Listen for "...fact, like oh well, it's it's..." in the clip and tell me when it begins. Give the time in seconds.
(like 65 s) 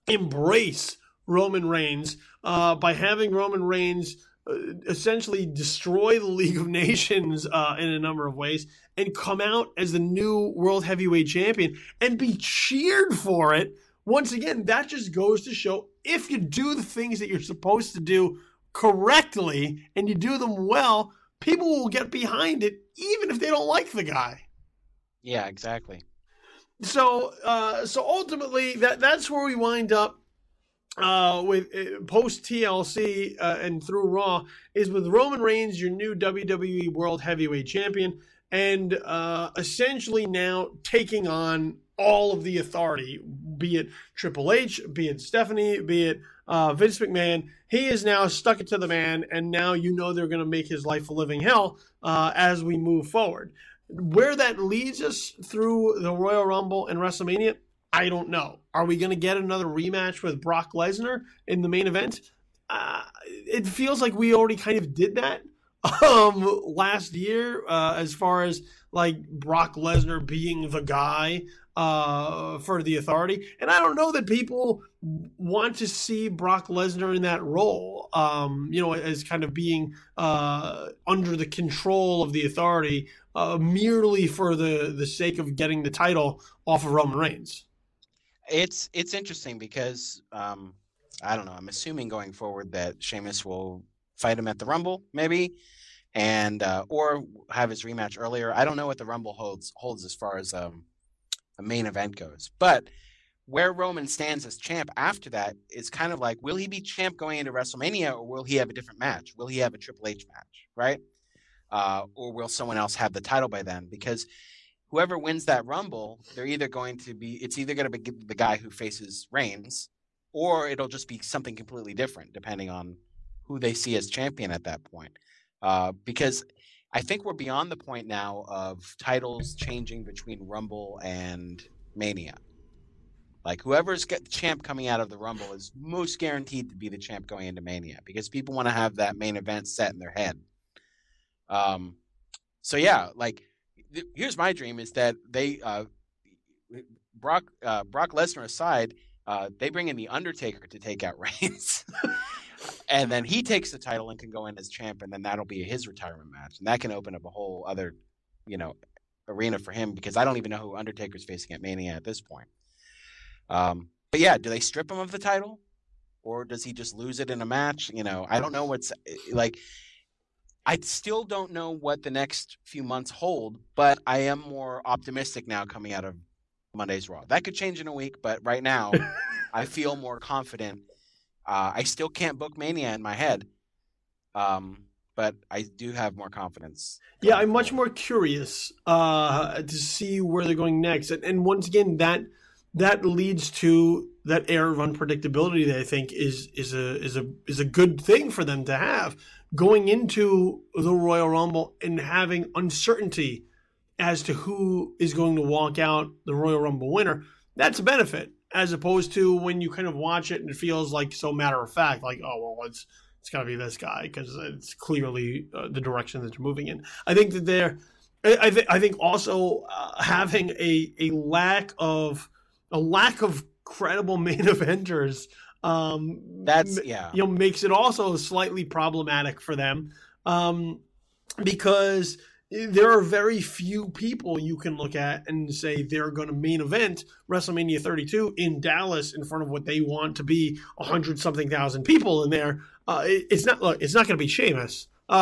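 211 s.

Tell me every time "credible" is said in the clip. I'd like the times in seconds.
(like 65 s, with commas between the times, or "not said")
223 s.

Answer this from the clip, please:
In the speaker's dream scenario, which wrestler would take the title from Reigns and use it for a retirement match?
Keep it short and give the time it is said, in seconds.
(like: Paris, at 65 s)
the Undertaker, at 149 s.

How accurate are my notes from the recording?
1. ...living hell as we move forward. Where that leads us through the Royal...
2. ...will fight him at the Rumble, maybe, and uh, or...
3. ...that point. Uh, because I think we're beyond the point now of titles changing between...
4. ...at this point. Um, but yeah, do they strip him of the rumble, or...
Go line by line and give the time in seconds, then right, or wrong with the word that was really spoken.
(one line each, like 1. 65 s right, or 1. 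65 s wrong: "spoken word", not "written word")
1. 51 s right
2. 93 s right
3. 124 s right
4. 161 s wrong: "title", not "rumble".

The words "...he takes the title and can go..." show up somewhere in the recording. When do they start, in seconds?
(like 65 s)
153 s.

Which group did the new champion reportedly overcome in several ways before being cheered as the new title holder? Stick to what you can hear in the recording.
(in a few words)
League of Nations.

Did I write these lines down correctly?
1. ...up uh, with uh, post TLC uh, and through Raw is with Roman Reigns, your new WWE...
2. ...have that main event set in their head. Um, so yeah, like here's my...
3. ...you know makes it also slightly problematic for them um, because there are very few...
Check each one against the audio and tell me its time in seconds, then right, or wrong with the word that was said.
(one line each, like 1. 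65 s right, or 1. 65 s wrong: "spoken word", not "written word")
1. 29 s right
2. 138 s right
3. 227 s right.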